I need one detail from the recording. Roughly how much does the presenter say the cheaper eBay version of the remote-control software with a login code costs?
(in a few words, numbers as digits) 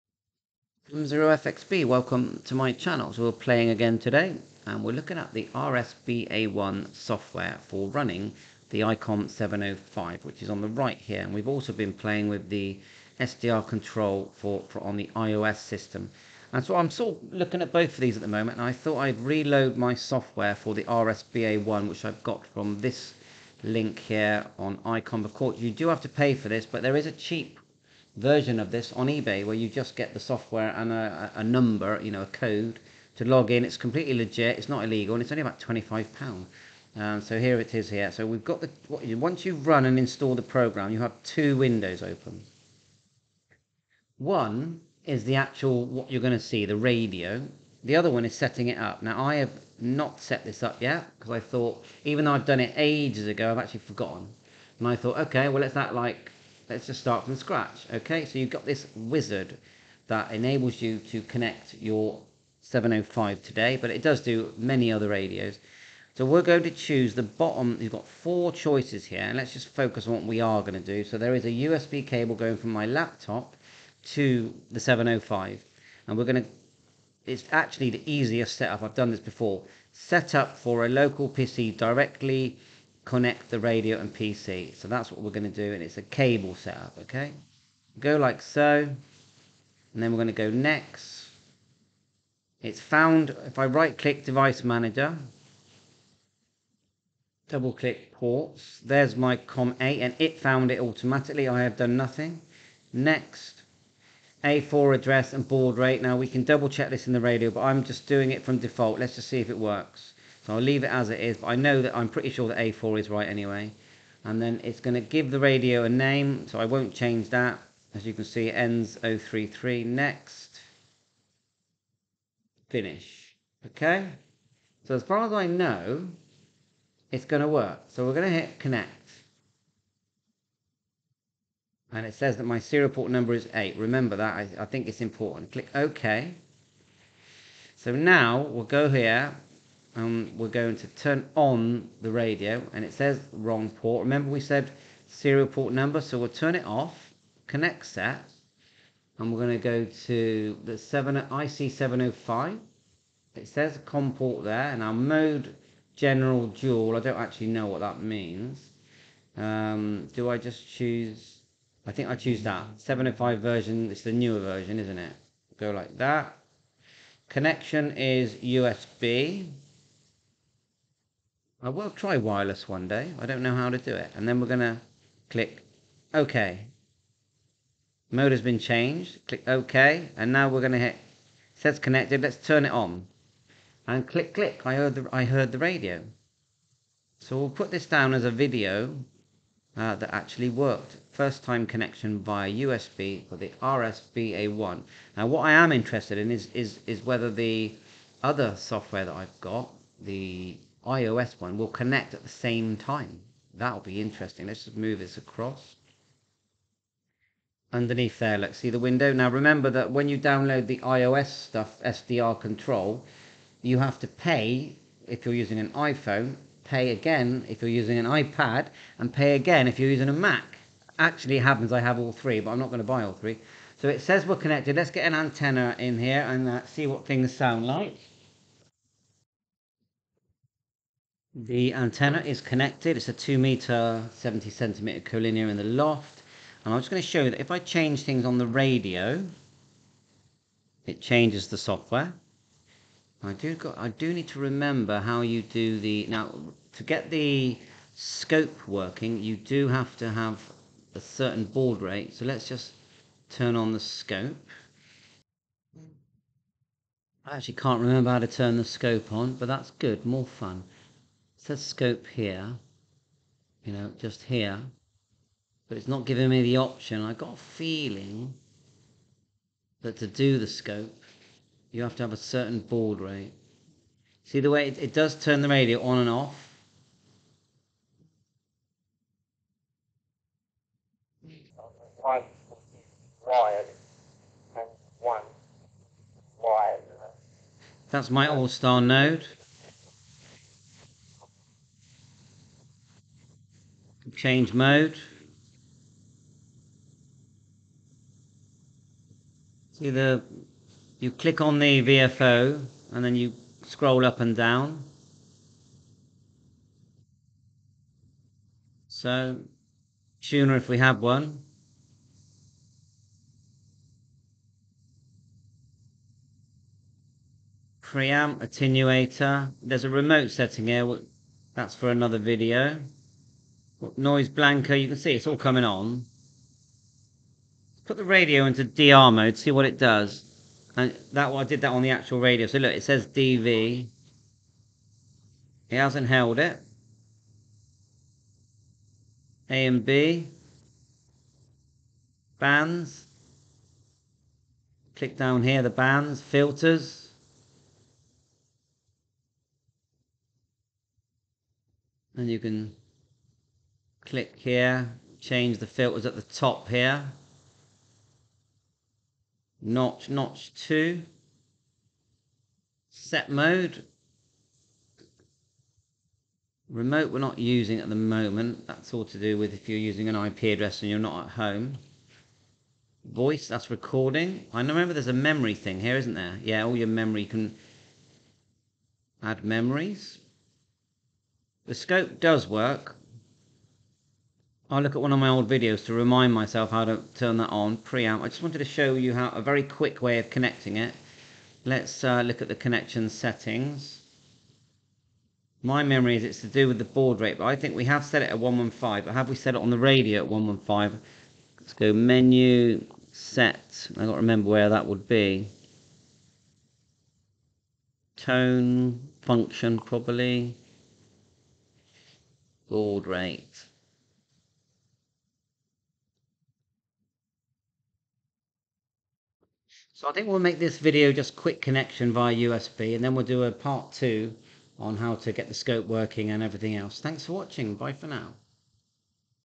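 25 pounds.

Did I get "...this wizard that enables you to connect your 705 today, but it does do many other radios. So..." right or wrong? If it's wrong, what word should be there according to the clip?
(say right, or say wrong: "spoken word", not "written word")
right.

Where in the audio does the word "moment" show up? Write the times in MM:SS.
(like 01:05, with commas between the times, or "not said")
00:18, 06:07.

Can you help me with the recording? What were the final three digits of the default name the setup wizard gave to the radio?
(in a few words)
033.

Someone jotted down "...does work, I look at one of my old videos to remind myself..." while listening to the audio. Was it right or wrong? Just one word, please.
right.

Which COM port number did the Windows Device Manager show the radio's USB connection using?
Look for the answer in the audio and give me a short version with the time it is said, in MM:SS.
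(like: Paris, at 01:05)
COM8, at 01:39.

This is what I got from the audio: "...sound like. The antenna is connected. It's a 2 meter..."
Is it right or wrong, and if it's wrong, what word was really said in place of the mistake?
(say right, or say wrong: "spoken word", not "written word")
right.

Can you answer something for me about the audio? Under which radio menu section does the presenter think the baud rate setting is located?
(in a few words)
Function.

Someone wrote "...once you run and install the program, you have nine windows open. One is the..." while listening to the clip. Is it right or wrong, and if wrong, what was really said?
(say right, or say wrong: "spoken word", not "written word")
wrong: "two", not "nine".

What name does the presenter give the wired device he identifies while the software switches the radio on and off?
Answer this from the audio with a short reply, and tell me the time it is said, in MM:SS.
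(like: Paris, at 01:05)
all-star node, at 04:48.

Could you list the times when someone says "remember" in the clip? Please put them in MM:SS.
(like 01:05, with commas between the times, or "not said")
02:13, 02:24, 03:29, 04:04, 04:17, 06:14, 06:44.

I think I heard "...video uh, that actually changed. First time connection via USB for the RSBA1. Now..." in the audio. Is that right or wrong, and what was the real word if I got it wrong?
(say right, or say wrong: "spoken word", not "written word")
wrong: "worked", not "changed".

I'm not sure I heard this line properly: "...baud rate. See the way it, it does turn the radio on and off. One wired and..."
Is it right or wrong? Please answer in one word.
right.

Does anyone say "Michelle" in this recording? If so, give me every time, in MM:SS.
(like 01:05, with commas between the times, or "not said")
not said.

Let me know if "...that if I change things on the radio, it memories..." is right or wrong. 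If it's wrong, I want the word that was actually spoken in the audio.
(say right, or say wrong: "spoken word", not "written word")
wrong: "changes", not "memories".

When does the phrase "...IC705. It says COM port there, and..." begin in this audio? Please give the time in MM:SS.
02:31.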